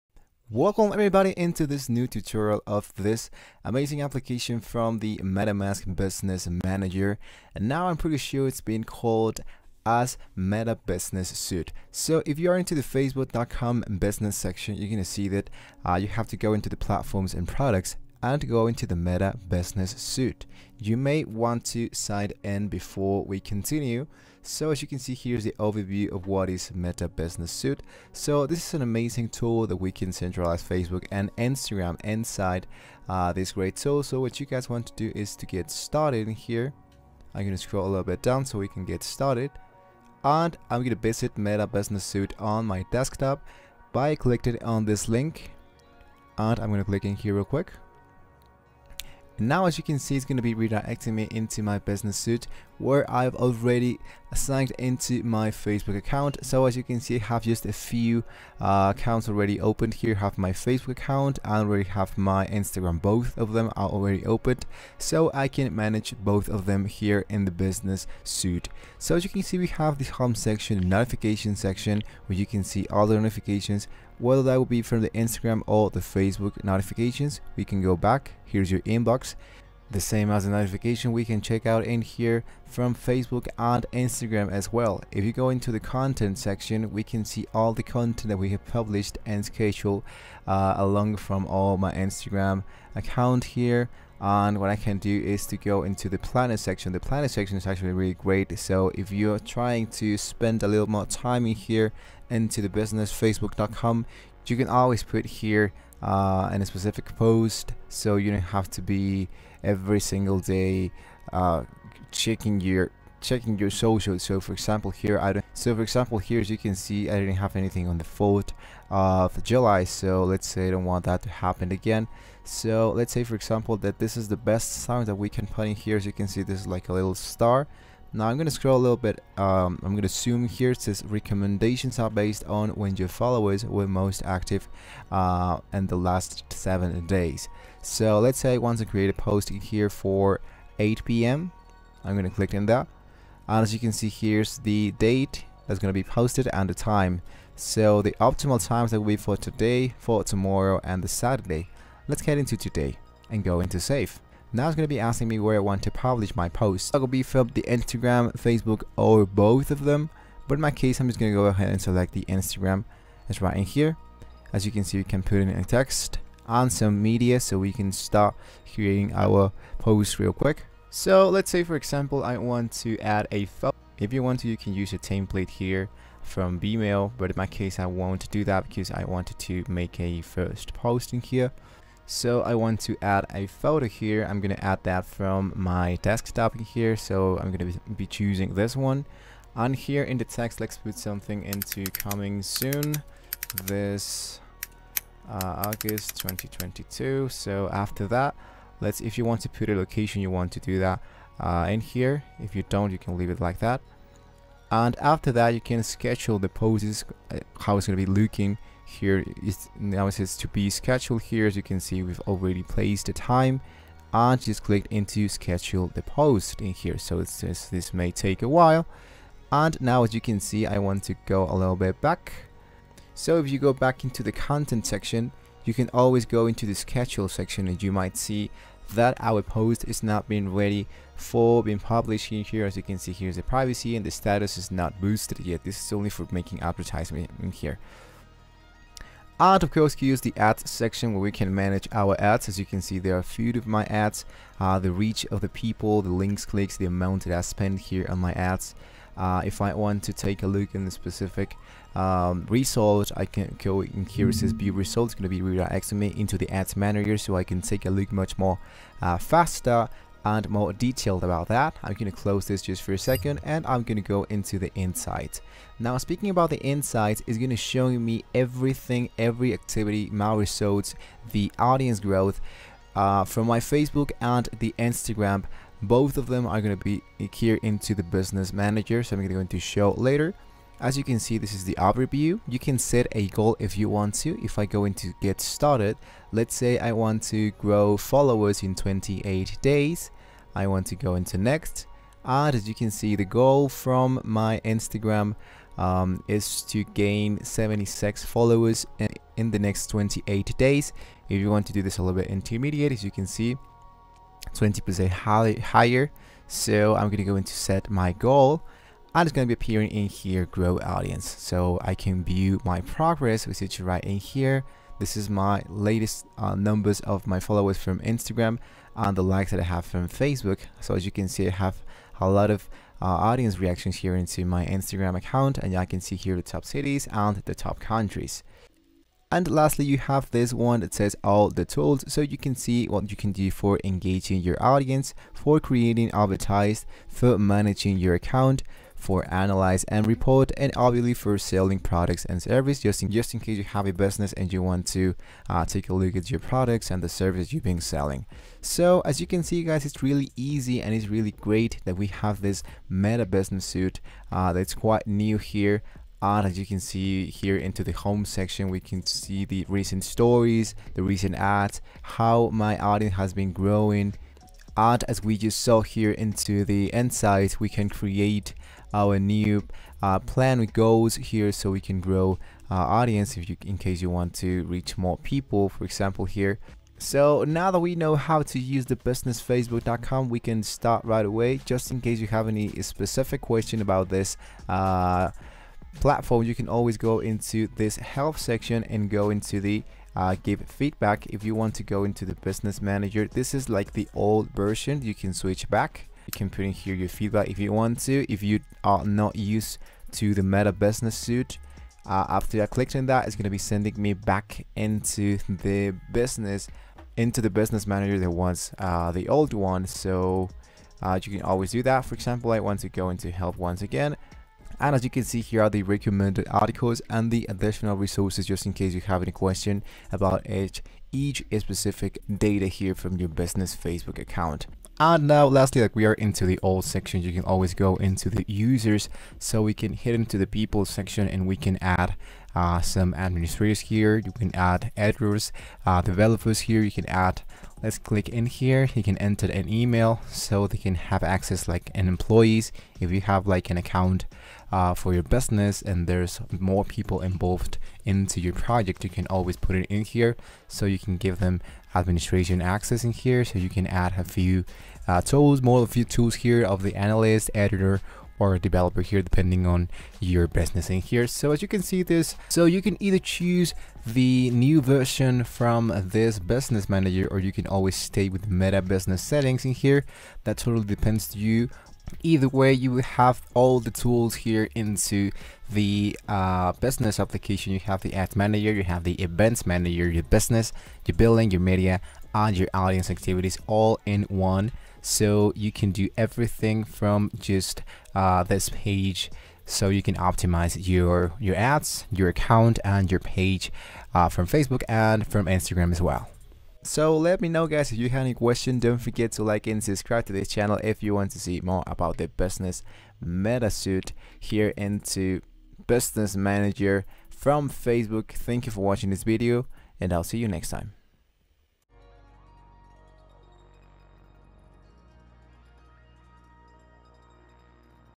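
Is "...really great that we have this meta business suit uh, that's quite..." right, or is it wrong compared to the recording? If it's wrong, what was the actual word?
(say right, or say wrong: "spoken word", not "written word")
right.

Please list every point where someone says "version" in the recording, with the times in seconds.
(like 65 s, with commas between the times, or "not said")
394 s, 464 s.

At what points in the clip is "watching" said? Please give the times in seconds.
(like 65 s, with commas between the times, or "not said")
508 s.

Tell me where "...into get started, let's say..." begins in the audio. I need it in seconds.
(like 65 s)
284 s.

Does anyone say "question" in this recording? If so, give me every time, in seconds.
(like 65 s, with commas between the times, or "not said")
383 s, 419 s, 498 s.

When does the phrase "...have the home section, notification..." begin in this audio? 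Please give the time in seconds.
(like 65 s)
69 s.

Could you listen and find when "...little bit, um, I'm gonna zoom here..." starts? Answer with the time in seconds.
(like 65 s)
128 s.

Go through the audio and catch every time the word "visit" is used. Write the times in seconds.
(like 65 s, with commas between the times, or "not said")
40 s.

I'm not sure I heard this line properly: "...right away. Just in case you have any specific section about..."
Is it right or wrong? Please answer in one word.
wrong.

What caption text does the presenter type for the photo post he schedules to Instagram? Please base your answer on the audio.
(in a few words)
Coming soon August 2022.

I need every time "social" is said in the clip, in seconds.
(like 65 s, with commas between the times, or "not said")
113 s.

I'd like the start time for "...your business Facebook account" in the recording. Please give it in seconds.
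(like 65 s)
423 s.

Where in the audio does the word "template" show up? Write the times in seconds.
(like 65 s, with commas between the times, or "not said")
174 s.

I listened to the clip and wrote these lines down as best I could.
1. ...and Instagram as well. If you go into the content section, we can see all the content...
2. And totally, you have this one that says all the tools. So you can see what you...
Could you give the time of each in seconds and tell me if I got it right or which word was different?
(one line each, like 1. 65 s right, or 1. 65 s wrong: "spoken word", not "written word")
1. 83 s right
2. 329 s wrong: "lastly", not "totally".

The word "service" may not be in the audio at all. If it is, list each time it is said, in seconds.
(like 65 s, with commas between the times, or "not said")
342 s, 347 s.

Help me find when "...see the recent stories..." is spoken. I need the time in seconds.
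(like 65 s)
359 s.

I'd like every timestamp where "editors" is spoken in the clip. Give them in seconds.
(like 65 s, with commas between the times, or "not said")
434 s, 457 s.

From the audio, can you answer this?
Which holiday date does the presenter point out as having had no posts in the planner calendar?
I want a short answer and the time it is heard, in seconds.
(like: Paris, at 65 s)
4th of July, at 118 s.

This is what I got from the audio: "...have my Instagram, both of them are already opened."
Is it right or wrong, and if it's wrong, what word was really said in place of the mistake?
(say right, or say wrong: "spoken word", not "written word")
right.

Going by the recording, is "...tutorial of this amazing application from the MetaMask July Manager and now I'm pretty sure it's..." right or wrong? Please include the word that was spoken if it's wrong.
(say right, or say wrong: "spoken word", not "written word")
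wrong: "Business", not "July".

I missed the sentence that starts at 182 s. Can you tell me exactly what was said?
So I want to add a photo here.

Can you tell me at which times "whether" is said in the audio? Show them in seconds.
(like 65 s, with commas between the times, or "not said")
74 s.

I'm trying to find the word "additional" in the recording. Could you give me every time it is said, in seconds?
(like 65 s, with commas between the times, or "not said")
417 s.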